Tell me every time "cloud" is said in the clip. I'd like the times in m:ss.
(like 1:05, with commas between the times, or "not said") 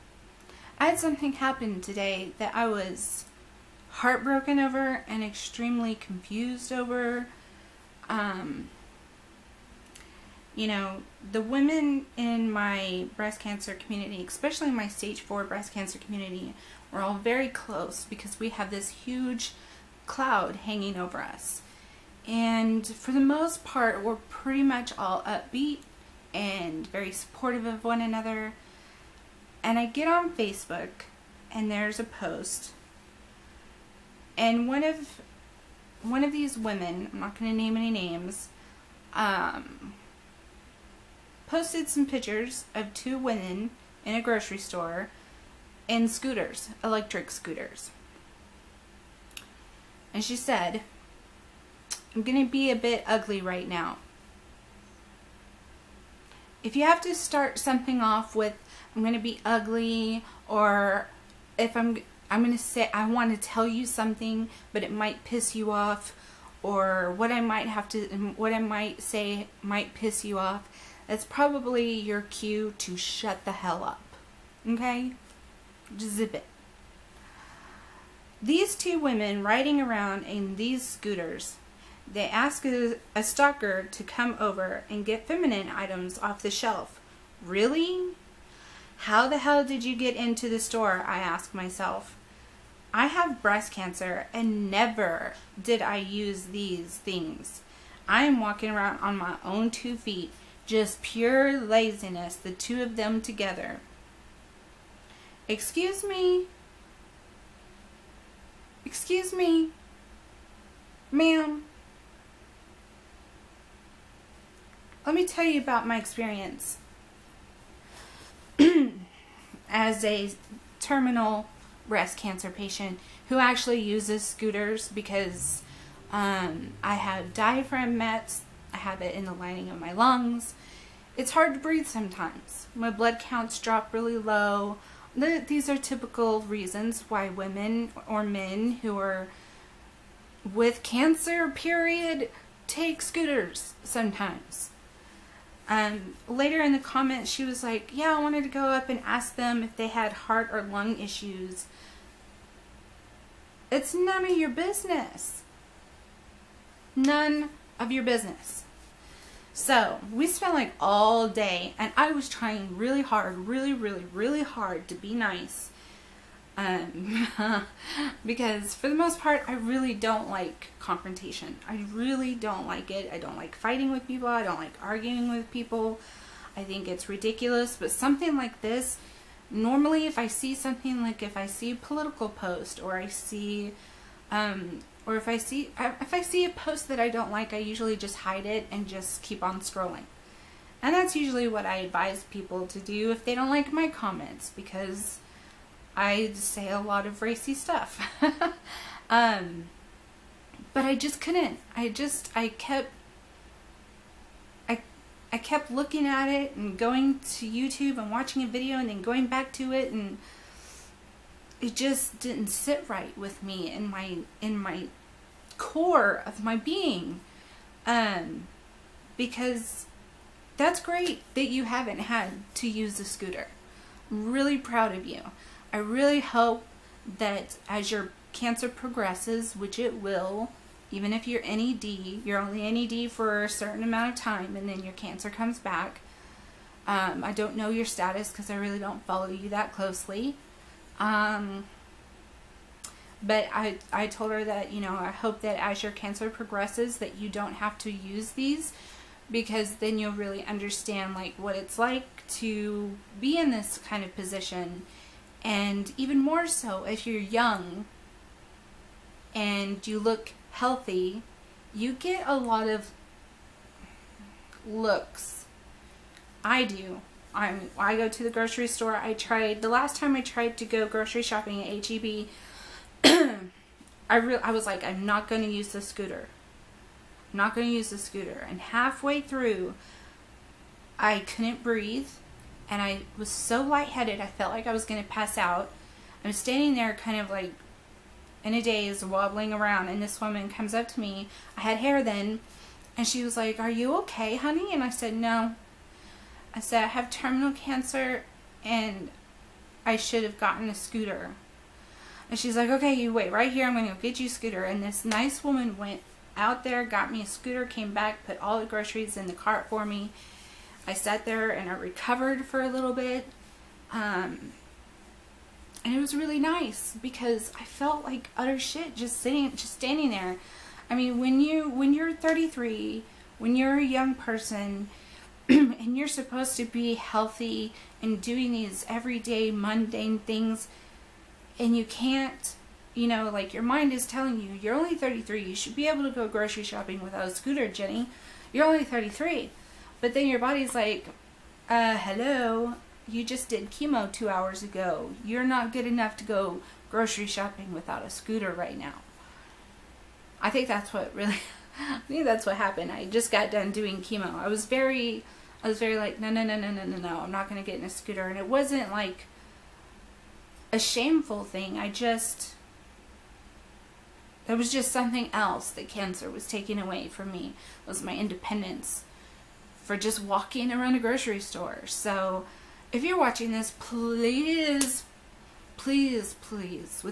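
0:20.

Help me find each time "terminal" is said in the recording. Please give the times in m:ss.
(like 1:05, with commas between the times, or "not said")
2:00, 4:57.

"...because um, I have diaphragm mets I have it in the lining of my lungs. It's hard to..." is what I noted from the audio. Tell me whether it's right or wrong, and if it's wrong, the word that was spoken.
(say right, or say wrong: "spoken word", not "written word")
right.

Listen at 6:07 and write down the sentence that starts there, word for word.
It was my independence for just walking around a grocery store.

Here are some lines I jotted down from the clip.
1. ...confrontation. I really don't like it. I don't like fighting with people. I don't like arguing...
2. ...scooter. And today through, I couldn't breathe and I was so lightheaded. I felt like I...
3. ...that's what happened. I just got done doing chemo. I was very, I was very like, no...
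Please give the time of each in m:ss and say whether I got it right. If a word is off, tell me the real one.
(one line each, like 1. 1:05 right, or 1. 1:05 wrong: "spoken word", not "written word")
1. 2:50 right
2. 4:37 wrong: "halfway", not "today"
3. 5:52 right.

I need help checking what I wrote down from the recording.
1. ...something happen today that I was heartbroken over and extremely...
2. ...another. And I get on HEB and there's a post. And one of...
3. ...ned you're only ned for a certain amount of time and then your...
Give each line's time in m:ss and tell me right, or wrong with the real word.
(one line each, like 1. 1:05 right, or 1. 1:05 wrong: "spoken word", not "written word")
1. 0:00 right
2. 0:27 wrong: "Facebook", not "HEB"
3. 3:51 right.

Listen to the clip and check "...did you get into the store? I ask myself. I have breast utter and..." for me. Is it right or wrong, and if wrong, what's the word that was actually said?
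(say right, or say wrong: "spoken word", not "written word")
wrong: "cancer", not "utter".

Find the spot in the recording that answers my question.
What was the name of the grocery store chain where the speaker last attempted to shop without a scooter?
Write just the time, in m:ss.
4:31.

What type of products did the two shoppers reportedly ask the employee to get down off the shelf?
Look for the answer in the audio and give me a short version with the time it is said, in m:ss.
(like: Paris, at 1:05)
feminine items, at 1:25.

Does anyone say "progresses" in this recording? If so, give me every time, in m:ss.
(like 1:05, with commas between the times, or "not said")
3:48, 4:06.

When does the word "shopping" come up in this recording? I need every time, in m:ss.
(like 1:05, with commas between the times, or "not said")
4:31, 5:36, 5:47.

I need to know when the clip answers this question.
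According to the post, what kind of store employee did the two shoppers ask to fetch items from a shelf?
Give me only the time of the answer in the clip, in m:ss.
1:23.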